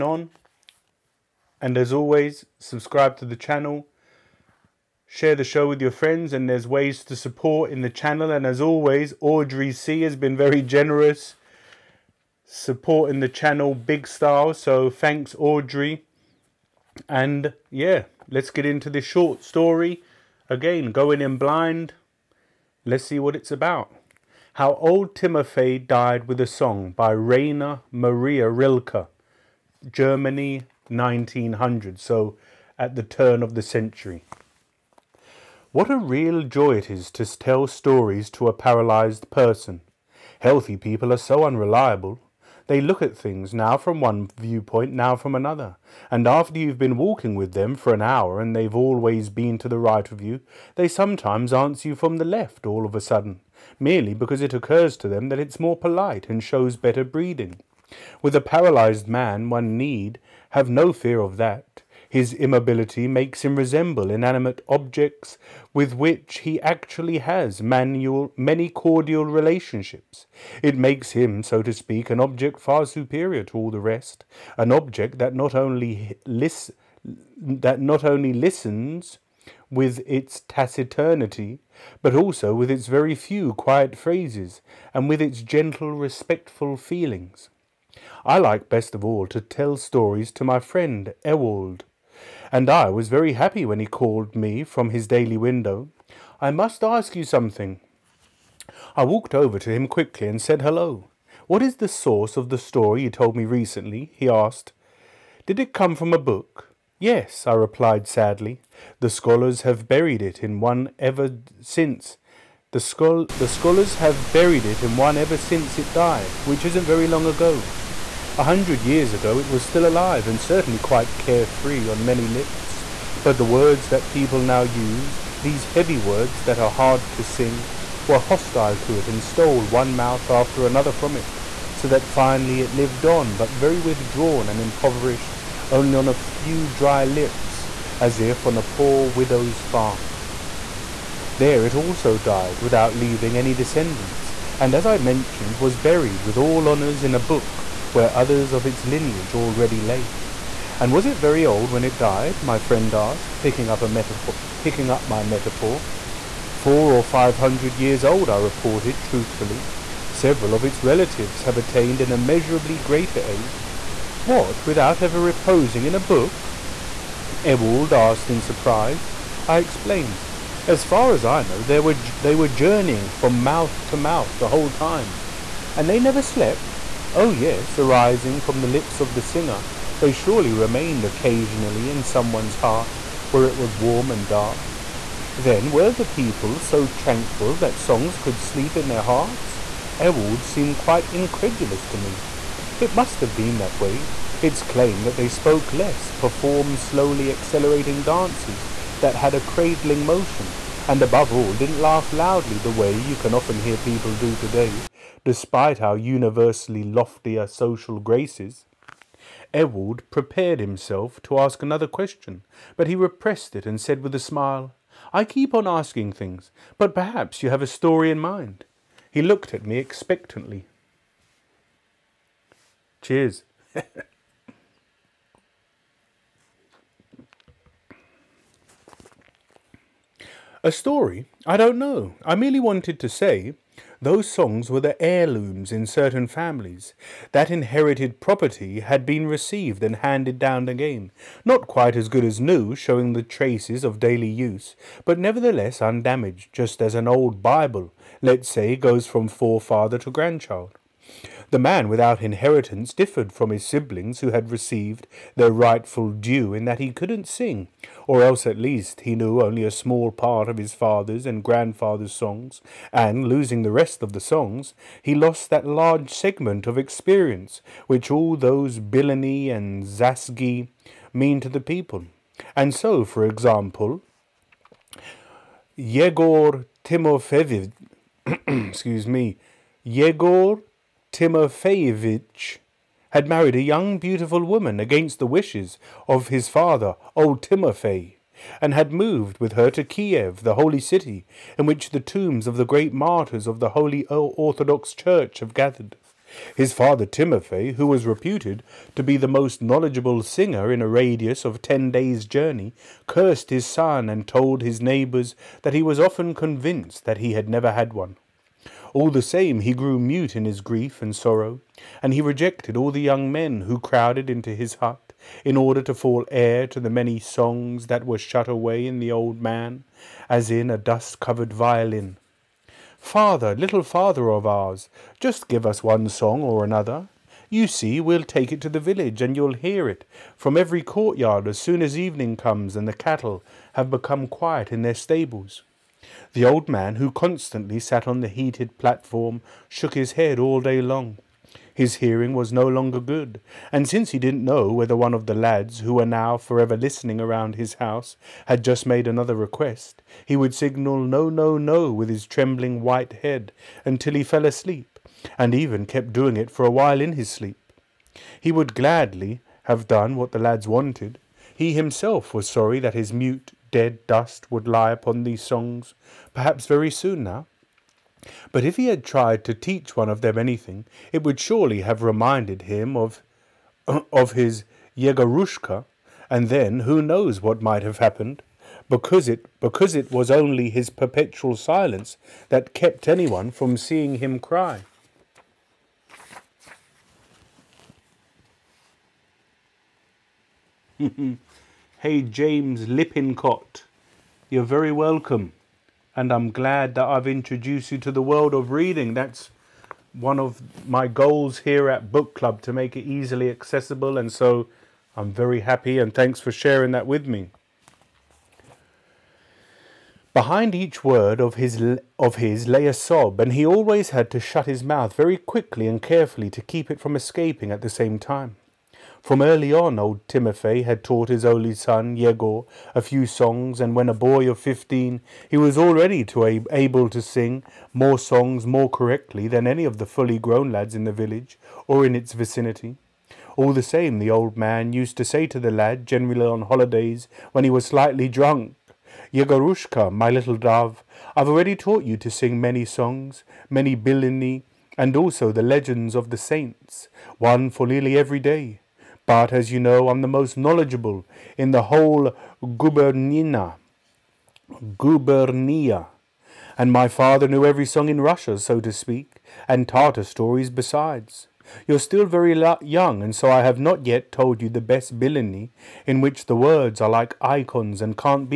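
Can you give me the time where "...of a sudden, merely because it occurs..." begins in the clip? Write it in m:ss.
0:52.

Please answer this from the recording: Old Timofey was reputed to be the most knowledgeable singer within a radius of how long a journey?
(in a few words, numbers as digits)
10 days.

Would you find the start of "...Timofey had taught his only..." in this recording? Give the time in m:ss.
7:00.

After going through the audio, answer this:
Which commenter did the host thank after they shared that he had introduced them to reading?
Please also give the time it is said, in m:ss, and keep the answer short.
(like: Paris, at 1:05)
James Lippincott, at 6:32.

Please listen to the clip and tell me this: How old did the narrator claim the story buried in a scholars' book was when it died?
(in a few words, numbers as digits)
Four or five hundred years.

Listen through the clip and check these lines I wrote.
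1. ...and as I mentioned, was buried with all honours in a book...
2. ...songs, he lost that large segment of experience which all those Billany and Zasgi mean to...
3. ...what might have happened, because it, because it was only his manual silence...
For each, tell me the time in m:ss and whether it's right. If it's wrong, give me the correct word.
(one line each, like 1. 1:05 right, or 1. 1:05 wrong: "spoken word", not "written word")
1. 2:24 right
2. 4:24 right
3. 6:17 wrong: "perpetual", not "manual".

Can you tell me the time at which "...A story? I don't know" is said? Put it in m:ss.
3:50.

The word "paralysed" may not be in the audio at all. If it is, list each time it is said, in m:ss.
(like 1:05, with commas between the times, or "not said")
0:38, 0:58.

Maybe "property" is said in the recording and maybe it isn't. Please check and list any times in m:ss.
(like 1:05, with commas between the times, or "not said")
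3:58.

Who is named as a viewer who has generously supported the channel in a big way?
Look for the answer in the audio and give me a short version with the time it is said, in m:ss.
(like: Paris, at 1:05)
Audrey C, at 0:09.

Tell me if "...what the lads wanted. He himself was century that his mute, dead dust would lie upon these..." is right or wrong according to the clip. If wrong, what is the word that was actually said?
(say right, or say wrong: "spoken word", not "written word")
wrong: "sorry", not "century".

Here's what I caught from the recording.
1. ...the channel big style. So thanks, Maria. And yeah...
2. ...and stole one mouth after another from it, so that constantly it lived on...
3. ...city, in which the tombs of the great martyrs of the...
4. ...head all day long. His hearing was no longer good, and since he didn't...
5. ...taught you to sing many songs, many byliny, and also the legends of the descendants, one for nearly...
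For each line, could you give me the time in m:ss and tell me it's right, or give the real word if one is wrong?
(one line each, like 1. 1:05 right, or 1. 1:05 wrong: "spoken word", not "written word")
1. 0:13 wrong: "Audrey", not "Maria"
2. 2:09 wrong: "finally", not "constantly"
3. 4:50 right
4. 5:40 right
5. 7:21 wrong: "saints", not "descendants".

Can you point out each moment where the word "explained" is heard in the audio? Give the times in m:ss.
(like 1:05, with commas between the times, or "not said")
2:49.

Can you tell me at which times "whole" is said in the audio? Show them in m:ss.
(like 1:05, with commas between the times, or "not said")
2:54, 7:31.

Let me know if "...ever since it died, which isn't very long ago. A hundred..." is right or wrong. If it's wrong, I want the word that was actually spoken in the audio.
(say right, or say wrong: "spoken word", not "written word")
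right.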